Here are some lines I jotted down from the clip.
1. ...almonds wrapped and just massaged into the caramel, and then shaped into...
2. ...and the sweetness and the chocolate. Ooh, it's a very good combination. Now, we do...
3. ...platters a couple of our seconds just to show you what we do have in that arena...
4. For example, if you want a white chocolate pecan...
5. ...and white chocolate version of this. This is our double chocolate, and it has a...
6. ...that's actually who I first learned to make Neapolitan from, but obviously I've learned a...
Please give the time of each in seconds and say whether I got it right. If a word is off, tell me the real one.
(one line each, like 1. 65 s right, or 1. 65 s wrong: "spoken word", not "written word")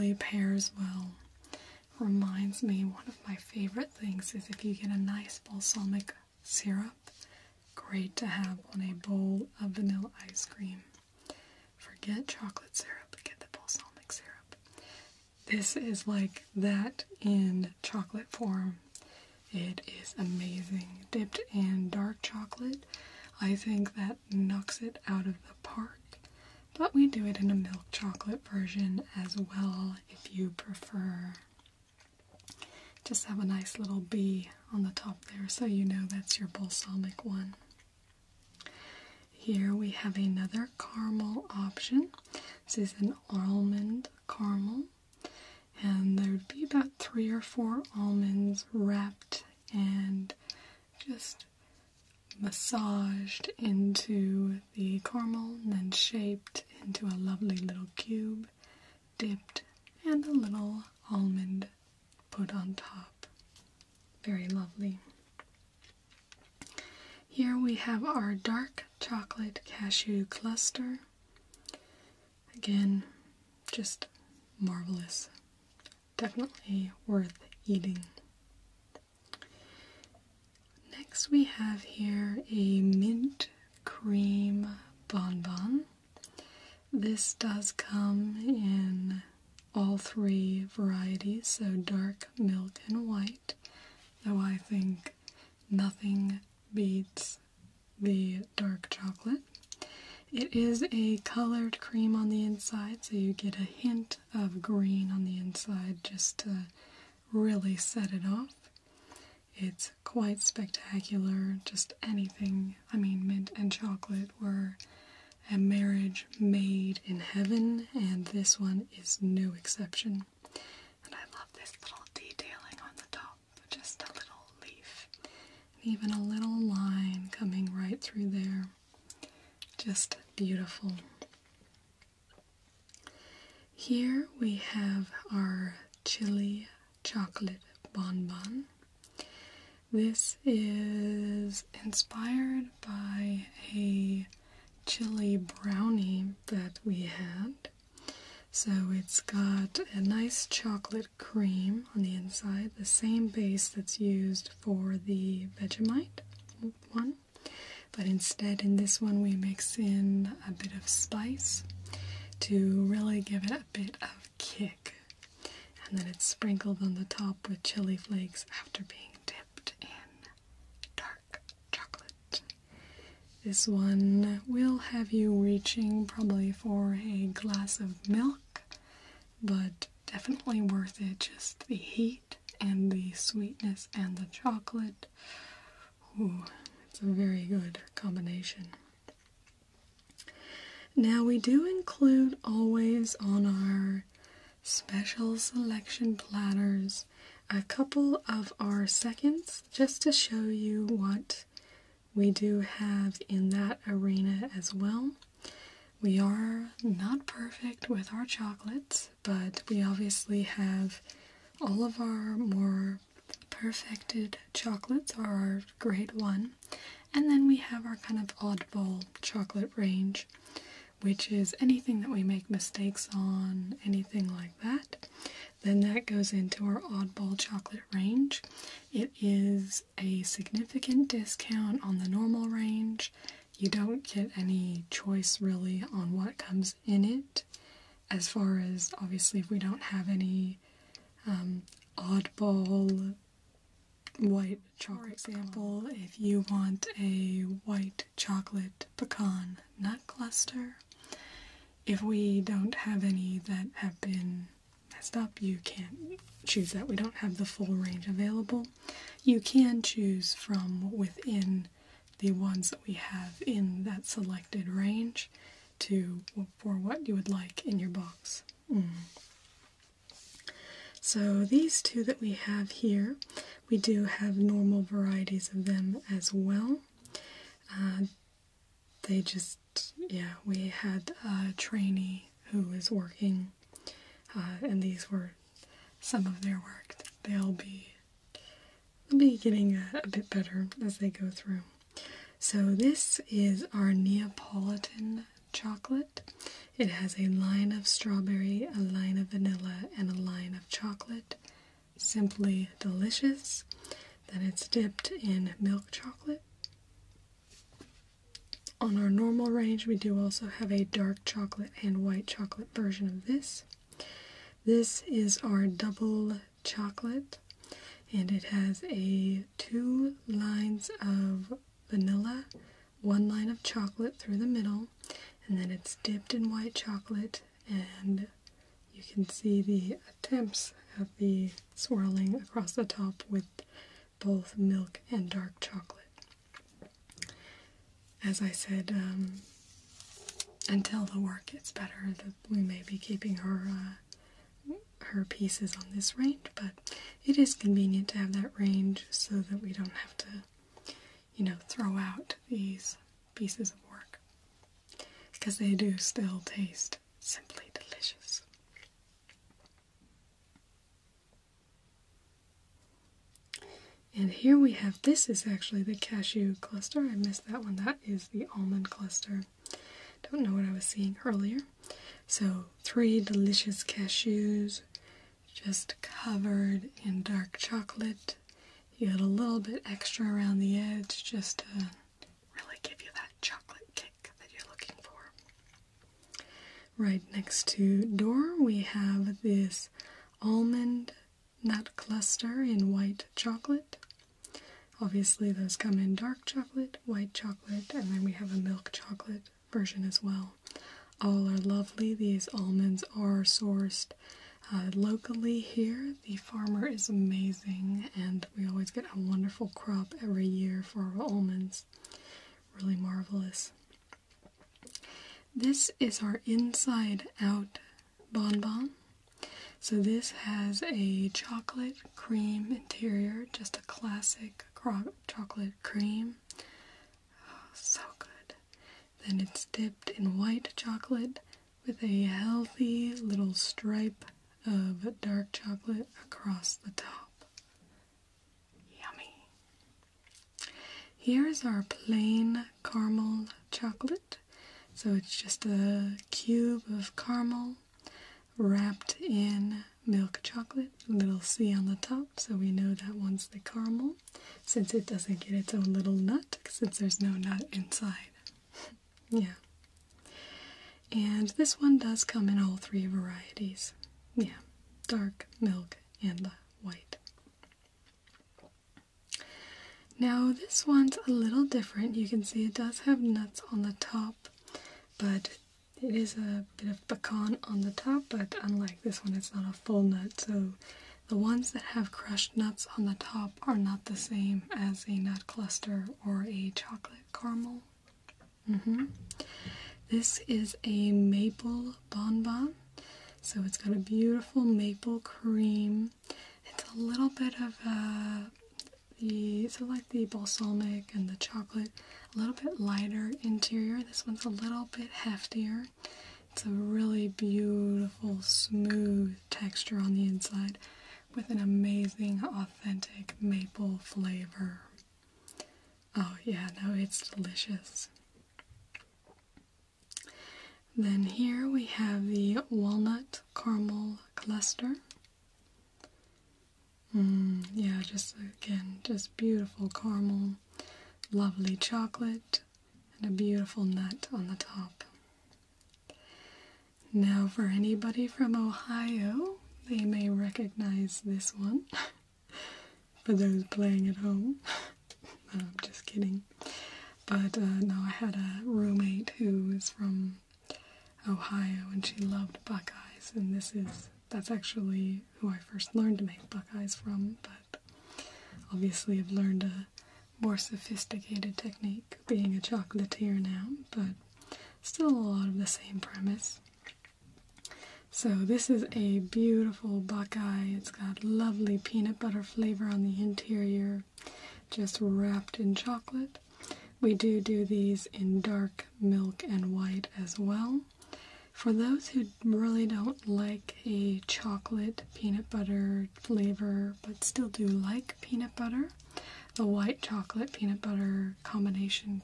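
1. 47 s right
2. 182 s right
3. 196 s right
4. 245 s right
5. 311 s right
6. 554 s wrong: "Buckeyes", not "Neapolitan".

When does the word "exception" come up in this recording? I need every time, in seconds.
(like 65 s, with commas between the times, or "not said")
119 s.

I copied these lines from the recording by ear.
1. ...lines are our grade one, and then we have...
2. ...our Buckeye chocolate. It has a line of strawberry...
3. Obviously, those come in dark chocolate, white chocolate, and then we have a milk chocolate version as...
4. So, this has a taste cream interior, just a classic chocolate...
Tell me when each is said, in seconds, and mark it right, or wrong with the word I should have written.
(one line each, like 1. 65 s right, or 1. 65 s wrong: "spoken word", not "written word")
1. 214 s wrong: "chocolates", not "lines"
2. 293 s wrong: "Neapolitan", not "Buckeye"
3. 395 s right
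4. 419 s wrong: "chocolate", not "taste".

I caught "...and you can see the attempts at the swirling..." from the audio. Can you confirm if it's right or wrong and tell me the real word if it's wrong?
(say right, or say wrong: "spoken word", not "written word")
right.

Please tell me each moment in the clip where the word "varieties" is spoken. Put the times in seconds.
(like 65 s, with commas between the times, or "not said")
90 s, 274 s, 463 s.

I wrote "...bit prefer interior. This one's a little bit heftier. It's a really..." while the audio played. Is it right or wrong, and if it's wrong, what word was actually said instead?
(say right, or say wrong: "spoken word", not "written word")
wrong: "lighter", not "prefer".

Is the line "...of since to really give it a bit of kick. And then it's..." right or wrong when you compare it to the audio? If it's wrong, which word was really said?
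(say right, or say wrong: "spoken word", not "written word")
wrong: "spice", not "since".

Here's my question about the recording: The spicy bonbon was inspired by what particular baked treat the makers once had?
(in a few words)
A chili brownie.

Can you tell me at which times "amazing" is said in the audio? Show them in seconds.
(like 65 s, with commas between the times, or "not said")
20 s, 407 s, 511 s.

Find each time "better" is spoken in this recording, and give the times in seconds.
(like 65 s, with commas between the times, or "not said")
290 s, 341 s.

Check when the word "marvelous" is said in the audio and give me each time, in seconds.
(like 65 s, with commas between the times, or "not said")
74 s, 412 s.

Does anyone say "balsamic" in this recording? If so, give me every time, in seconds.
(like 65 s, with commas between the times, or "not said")
5 s, 13 s, 36 s, 500 s.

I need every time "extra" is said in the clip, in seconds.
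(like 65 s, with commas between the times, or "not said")
379 s.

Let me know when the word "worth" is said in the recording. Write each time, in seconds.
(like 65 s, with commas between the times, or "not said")
77 s, 180 s.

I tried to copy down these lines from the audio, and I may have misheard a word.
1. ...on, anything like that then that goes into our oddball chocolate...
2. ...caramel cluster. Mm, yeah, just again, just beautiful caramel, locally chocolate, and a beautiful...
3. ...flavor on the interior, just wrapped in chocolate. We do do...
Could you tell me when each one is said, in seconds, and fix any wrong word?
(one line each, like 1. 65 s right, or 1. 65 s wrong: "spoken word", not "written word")
1. 223 s right
2. 523 s wrong: "lovely", not "locally"
3. 572 s right.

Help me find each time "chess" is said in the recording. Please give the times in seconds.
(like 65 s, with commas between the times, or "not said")
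not said.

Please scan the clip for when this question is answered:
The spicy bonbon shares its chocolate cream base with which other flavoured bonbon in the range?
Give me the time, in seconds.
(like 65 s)
155 s.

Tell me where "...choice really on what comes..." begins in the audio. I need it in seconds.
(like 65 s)
234 s.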